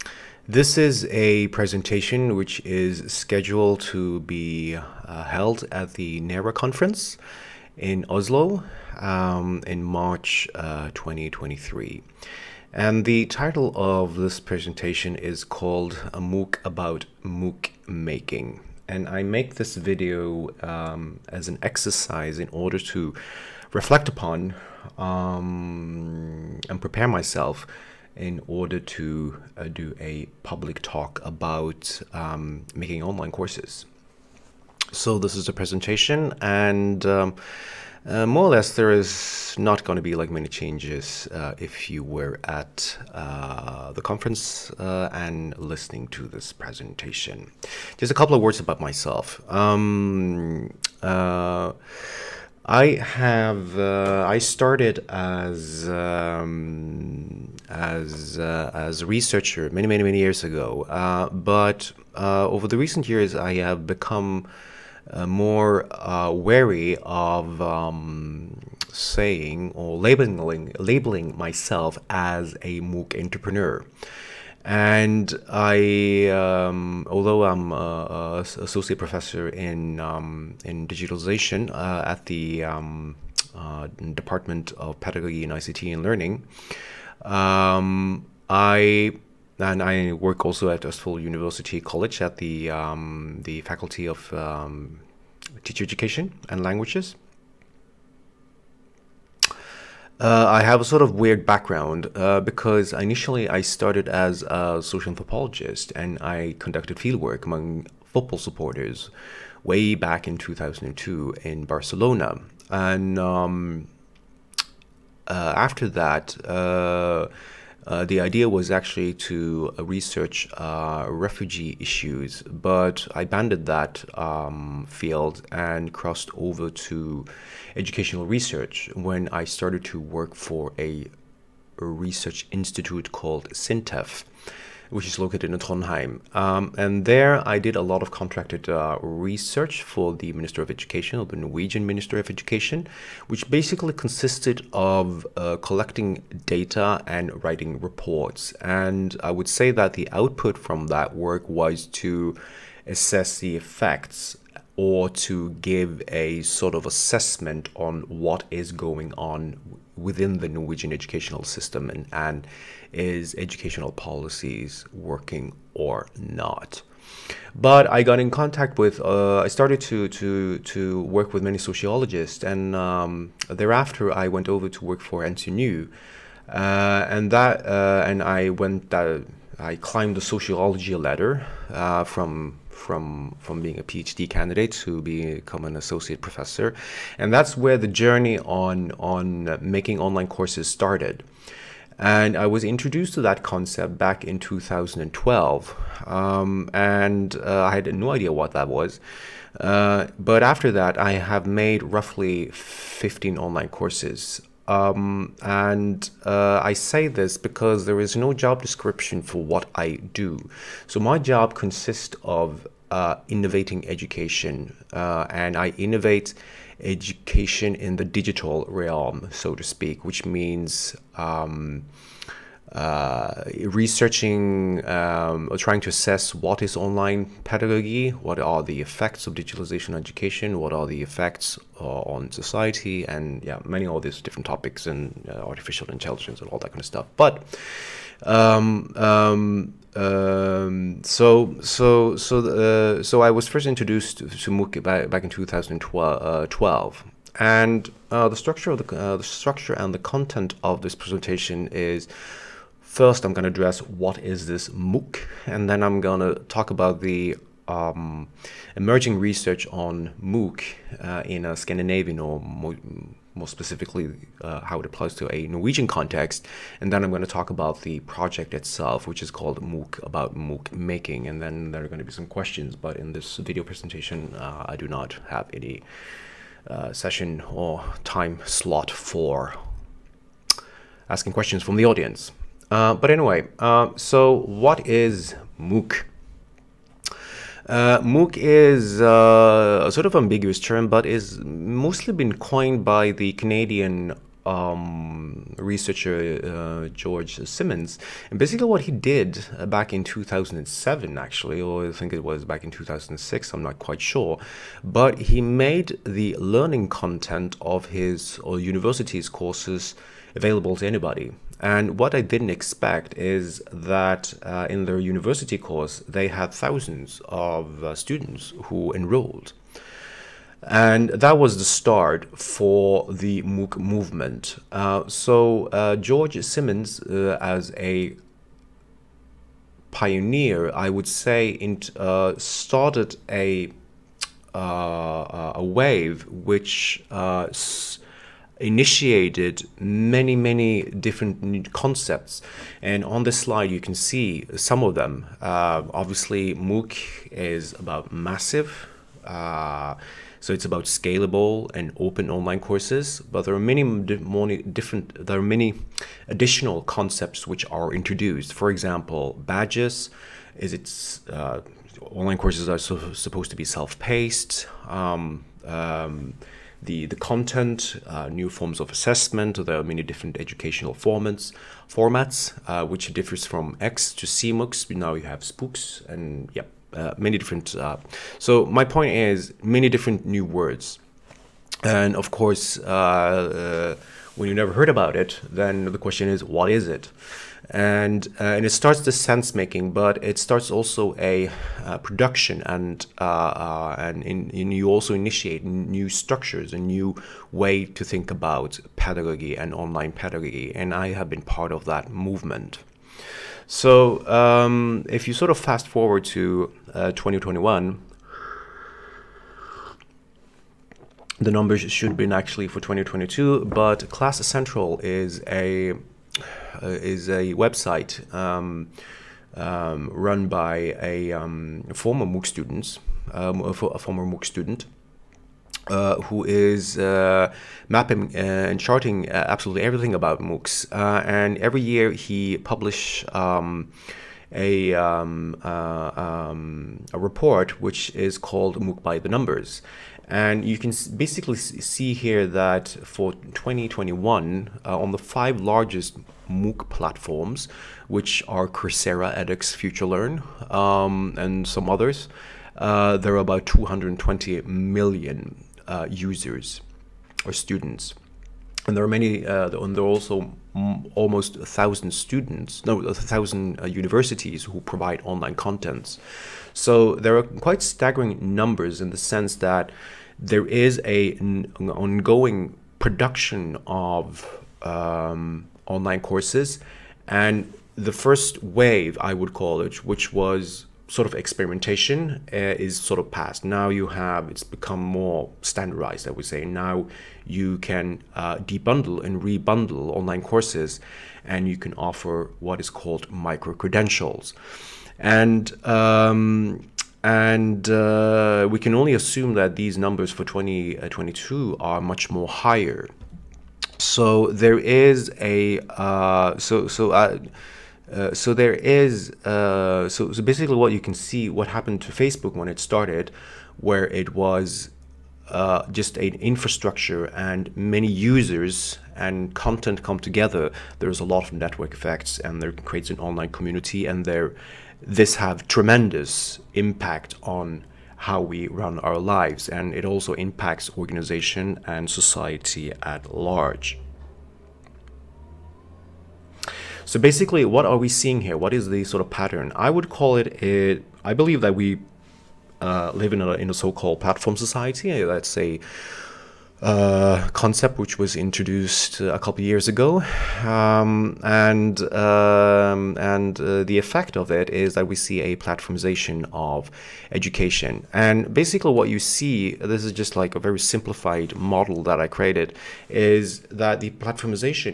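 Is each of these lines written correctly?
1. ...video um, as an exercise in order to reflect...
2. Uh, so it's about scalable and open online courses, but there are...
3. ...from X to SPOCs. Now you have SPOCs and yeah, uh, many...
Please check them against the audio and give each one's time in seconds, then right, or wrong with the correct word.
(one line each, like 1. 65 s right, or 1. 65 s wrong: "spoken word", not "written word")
1. 19 s right
2. 349 s right
3. 373 s wrong: "CMOOCs", not "SPOCs".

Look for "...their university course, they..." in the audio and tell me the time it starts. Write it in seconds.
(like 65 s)
314 s.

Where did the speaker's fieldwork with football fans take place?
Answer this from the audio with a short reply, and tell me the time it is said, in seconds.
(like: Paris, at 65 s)
Barcelona, at 111 s.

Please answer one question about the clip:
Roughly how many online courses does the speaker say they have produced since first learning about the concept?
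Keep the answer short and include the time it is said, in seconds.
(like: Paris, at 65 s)
15, at 202 s.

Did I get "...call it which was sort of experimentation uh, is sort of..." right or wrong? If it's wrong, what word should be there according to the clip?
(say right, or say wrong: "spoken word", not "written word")
right.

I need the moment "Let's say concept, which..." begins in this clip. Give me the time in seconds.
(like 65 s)
545 s.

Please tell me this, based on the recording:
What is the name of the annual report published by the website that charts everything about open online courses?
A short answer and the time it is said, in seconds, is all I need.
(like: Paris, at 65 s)
MOOC by the Numbers, at 438 s.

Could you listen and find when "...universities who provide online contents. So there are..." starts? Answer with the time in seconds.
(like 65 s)
463 s.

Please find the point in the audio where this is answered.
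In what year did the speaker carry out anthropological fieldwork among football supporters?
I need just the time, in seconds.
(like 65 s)
110 s.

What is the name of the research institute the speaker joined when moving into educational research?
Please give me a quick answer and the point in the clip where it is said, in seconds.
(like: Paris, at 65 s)
SINTEF, at 133 s.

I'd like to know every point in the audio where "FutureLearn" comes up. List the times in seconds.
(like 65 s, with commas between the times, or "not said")
449 s.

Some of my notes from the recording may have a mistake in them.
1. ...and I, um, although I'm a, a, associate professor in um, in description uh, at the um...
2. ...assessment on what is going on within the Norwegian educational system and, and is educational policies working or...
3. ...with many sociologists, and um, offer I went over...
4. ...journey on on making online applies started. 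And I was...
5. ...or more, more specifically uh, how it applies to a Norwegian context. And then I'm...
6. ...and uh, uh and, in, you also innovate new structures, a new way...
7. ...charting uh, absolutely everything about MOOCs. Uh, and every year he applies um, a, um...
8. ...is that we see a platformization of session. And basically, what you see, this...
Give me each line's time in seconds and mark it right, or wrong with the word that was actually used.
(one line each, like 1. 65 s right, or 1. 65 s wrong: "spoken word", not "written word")
1. 74 s wrong: "digitalization", not "description"
2. 156 s right
3. 171 s wrong: "thereafter", not "offer"
4. 188 s wrong: "courses", not "applies"
5. 262 s right
6. 392 s wrong: "initiate", not "innovate"
7. 428 s wrong: "publishes", not "applies"
8. 554 s wrong: "education", not "session".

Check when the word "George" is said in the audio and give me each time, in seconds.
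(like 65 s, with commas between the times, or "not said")
296 s, 325 s.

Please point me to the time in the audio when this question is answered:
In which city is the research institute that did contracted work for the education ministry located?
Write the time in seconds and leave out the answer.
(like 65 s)
135 s.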